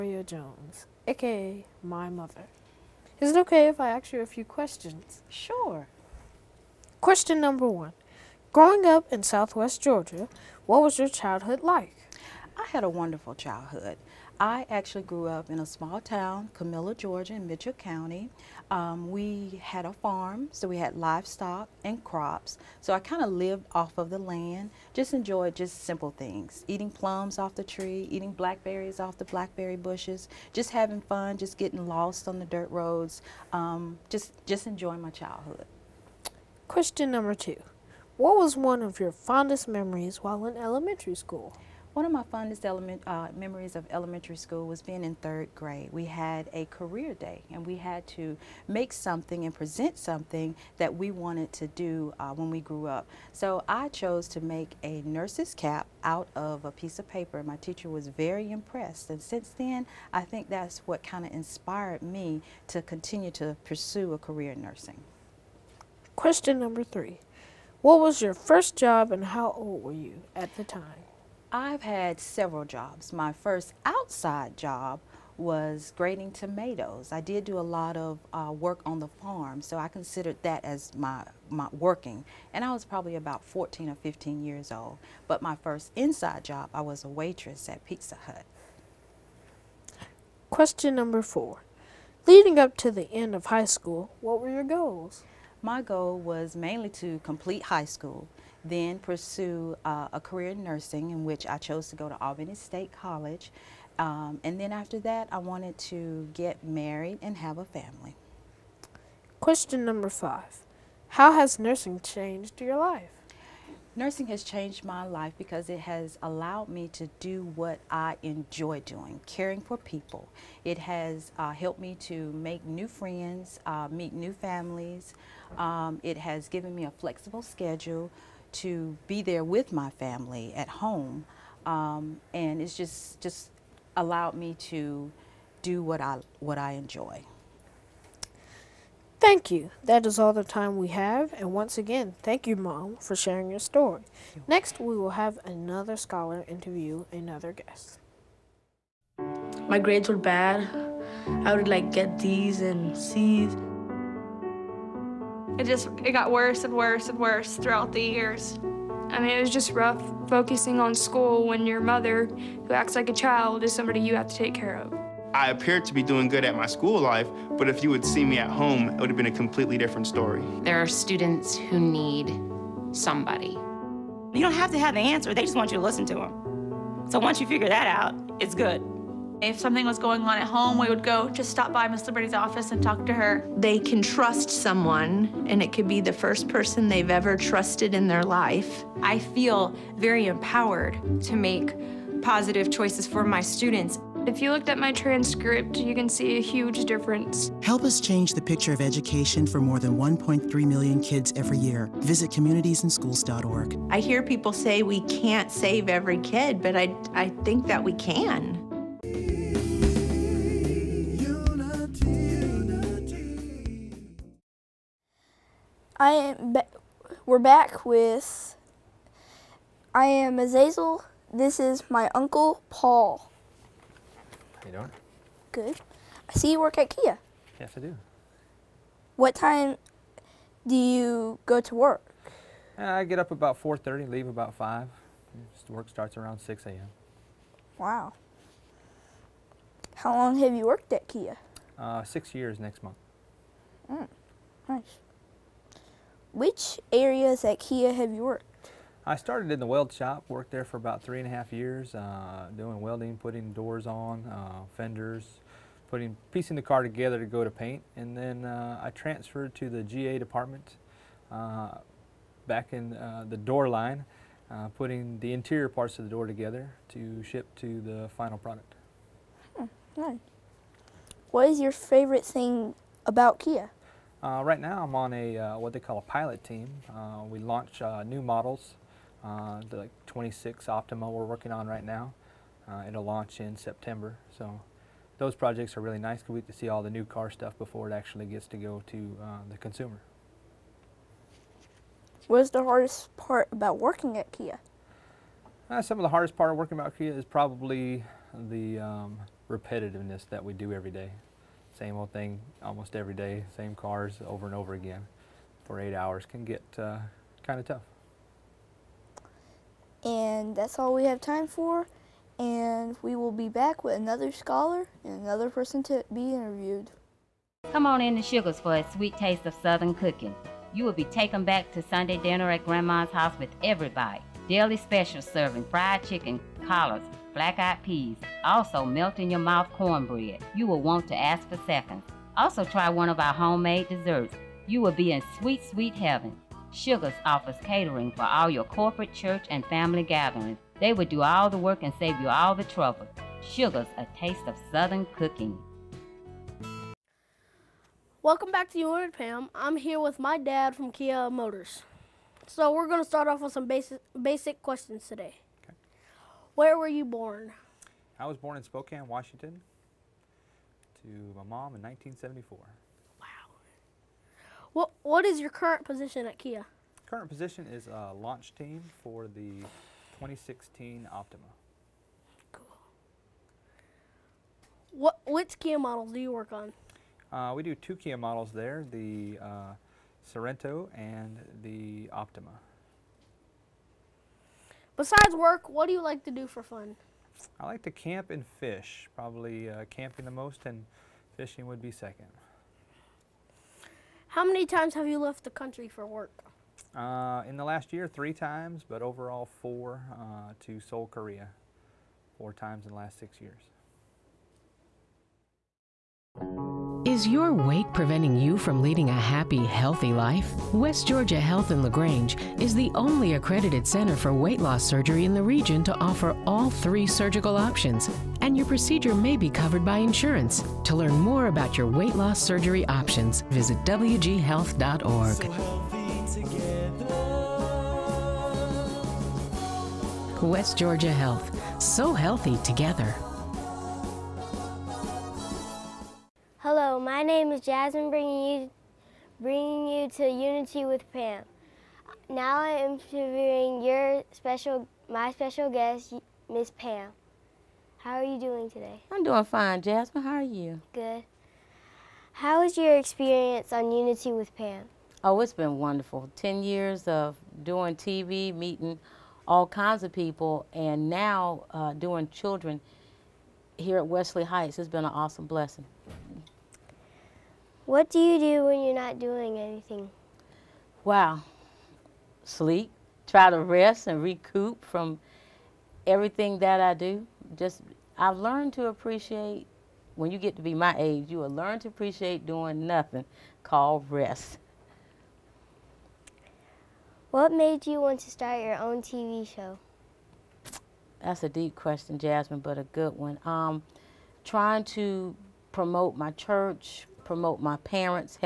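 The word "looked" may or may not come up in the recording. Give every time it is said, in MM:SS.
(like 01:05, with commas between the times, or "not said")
03:14.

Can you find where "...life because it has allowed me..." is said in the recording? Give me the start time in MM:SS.
01:55.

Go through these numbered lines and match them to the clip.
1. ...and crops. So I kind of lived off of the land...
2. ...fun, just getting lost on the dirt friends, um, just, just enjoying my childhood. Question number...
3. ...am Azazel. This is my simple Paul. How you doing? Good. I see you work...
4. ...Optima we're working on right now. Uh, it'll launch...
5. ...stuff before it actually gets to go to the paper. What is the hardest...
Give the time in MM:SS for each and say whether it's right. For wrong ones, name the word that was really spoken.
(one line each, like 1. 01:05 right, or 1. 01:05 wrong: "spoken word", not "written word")
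1. 00:21 right
2. 00:30 wrong: "roads", not "friends"
3. 03:40 wrong: "uncle", not "simple"
4. 04:40 right
5. 04:47 wrong: "consumer", not "paper".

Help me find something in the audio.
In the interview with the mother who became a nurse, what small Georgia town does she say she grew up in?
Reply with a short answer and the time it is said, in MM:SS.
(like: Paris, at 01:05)
Camilla, at 00:16.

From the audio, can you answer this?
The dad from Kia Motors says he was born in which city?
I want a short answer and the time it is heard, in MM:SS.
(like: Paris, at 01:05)
Spokane, Washington, at 05:58.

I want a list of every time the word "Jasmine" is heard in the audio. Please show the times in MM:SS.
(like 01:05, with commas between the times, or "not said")
07:17, 07:29, 08:12.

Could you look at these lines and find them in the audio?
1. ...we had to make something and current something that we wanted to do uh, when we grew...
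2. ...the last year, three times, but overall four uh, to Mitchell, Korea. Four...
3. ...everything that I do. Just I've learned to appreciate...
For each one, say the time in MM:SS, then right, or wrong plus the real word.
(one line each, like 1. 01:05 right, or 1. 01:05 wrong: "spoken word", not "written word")
1. 00:47 wrong: "present", not "current"
2. 06:37 wrong: "Seoul", not "Mitchell"
3. 07:56 right.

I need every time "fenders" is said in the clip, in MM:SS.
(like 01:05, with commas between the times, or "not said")
04:14.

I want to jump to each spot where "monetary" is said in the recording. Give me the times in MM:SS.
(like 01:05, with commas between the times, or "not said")
not said.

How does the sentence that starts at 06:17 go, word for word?
Uh, we do two Kia models there: the uh, Sorento and the Optima.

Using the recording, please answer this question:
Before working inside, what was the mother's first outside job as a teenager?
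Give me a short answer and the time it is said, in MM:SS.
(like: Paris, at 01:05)
Grading tomatoes, at 01:15.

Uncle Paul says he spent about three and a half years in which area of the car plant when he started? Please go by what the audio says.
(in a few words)
Weld shop.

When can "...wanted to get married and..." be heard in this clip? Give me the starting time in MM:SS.
01:45.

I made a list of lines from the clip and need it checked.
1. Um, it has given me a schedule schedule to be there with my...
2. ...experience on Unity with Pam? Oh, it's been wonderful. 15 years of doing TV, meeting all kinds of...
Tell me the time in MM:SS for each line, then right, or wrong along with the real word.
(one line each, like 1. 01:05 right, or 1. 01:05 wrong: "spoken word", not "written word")
1. 02:05 wrong: "flexible", not "schedule"
2. 07:32 wrong: "10", not "15".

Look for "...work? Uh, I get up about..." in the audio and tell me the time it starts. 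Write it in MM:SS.
03:51.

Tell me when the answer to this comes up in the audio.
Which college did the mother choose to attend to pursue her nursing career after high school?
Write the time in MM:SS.
01:42.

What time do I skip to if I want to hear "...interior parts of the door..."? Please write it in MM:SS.
04:25.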